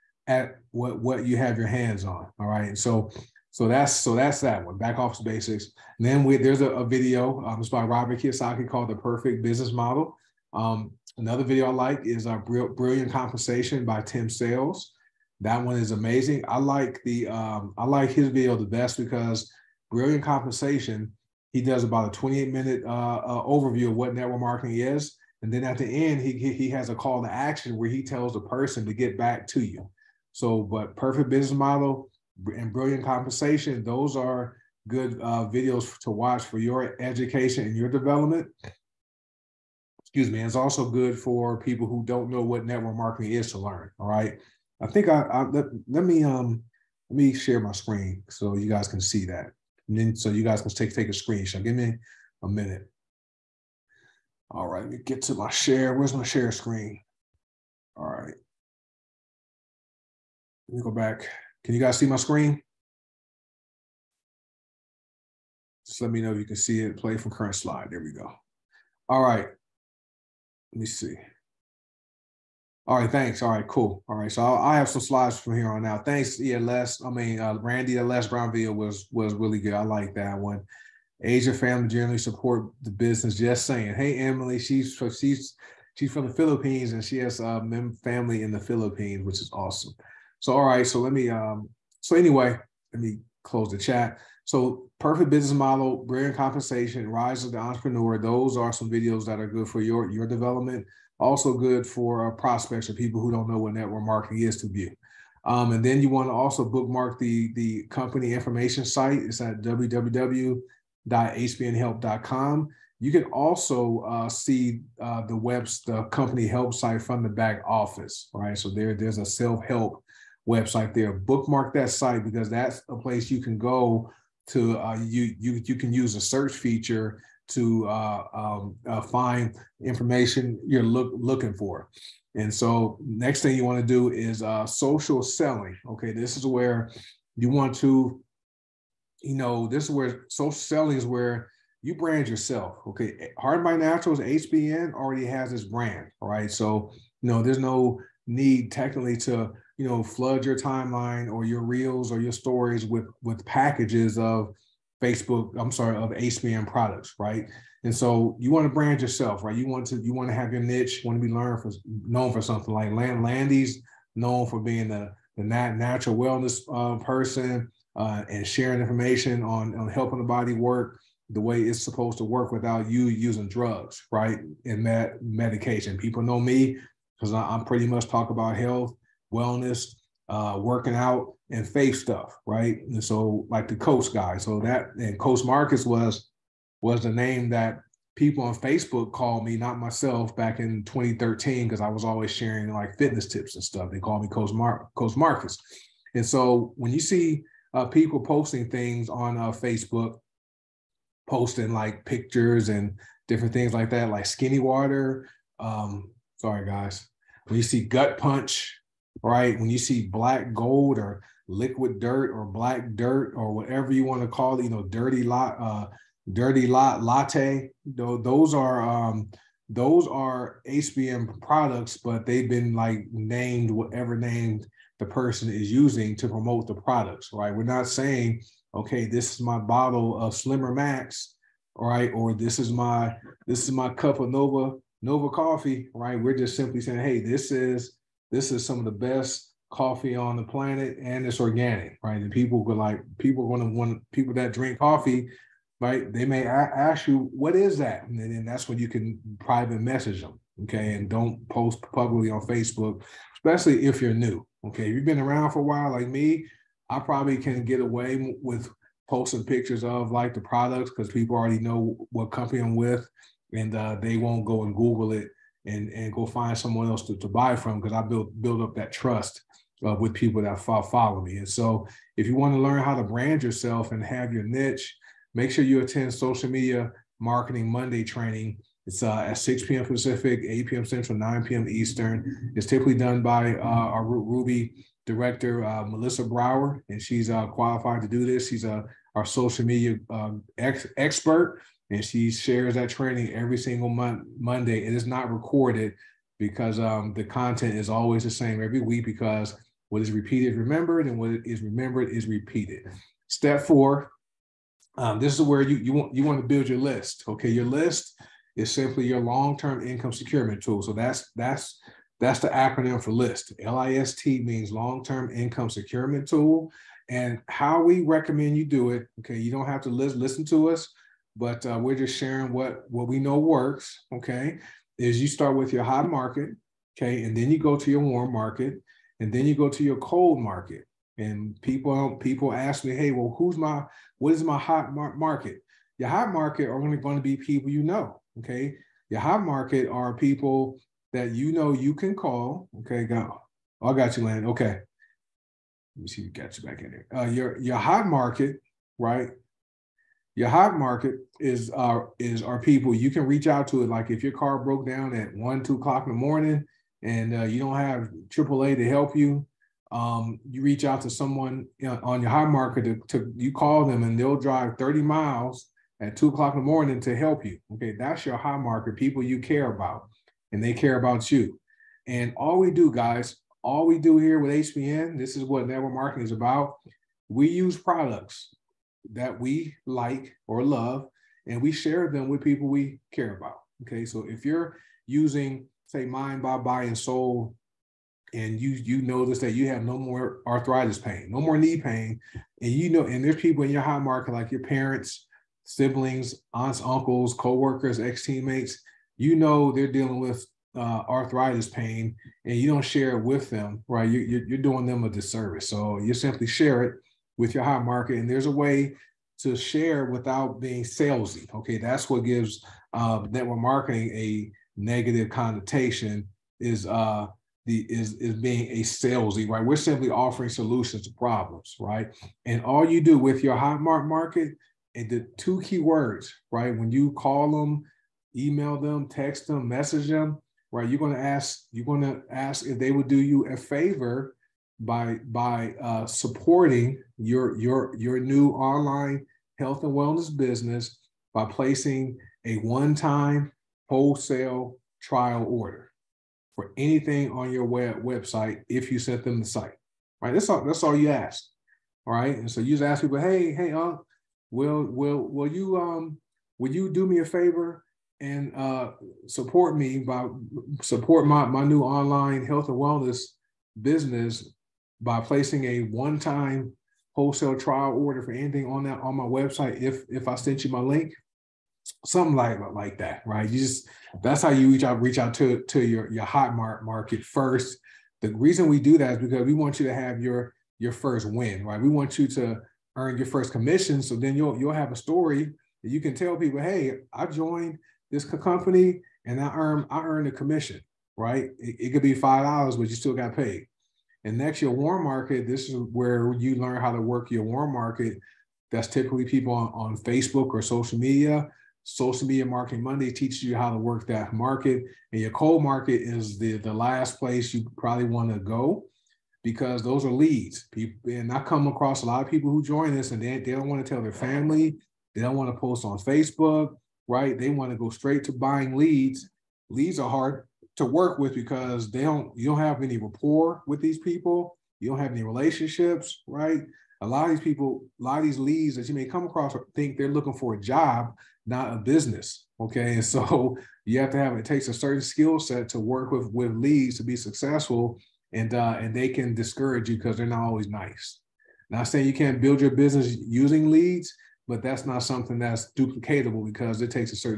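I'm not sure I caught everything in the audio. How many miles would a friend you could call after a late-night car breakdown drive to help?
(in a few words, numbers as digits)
30.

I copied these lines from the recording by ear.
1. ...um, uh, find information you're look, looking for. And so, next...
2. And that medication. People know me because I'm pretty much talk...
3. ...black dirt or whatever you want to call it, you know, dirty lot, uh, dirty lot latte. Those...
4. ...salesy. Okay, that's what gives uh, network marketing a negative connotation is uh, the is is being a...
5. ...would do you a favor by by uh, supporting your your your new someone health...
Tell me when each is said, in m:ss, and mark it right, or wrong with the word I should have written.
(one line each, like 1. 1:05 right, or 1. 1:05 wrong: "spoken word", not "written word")
1. 2:08 right
2. 2:54 right
3. 3:32 right
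4. 6:50 right
5. 7:12 wrong: "online", not "someone".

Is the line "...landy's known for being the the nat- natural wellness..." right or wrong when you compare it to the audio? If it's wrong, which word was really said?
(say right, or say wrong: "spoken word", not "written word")
right.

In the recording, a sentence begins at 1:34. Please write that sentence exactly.
So perfect business model, brilliant compensation, rise of the entrepreneur.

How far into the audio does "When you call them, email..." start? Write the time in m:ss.
7:06.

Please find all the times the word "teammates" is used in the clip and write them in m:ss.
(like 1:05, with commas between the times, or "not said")
6:37.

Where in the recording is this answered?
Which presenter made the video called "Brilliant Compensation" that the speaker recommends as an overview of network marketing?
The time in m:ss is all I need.
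0:14.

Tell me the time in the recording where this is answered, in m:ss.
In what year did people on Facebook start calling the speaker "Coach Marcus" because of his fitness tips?
3:10.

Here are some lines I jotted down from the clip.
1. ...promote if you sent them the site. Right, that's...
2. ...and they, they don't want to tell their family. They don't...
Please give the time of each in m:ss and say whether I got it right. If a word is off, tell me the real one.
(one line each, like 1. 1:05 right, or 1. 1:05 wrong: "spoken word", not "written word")
1. 7:28 wrong: "website", not "promote"
2. 8:33 right.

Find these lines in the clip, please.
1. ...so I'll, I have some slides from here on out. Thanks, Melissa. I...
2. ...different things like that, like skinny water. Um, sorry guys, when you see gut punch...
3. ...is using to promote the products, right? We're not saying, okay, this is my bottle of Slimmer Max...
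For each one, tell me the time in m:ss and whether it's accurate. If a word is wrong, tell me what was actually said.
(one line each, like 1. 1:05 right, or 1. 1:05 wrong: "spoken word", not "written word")
1. 1:14 wrong: "ELS", not "Melissa"
2. 3:23 right
3. 3:45 right.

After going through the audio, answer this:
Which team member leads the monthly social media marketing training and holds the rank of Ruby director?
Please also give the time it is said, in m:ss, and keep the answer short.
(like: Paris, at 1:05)
Melissa Brower, at 4:45.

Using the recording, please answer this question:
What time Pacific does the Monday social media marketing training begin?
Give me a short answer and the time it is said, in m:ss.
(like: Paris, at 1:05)
6 p.m., at 4:39.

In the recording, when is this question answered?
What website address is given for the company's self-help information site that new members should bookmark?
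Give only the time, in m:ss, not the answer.
1:49.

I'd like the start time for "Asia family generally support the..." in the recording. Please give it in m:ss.
1:21.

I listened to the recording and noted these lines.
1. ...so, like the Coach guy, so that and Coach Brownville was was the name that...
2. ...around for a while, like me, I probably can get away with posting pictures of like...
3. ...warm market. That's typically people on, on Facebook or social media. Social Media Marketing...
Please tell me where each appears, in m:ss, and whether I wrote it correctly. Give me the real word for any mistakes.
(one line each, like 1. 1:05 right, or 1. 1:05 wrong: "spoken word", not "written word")
1. 3:03 wrong: "Marcus", not "Brownville"
2. 4:15 right
3. 8:17 right.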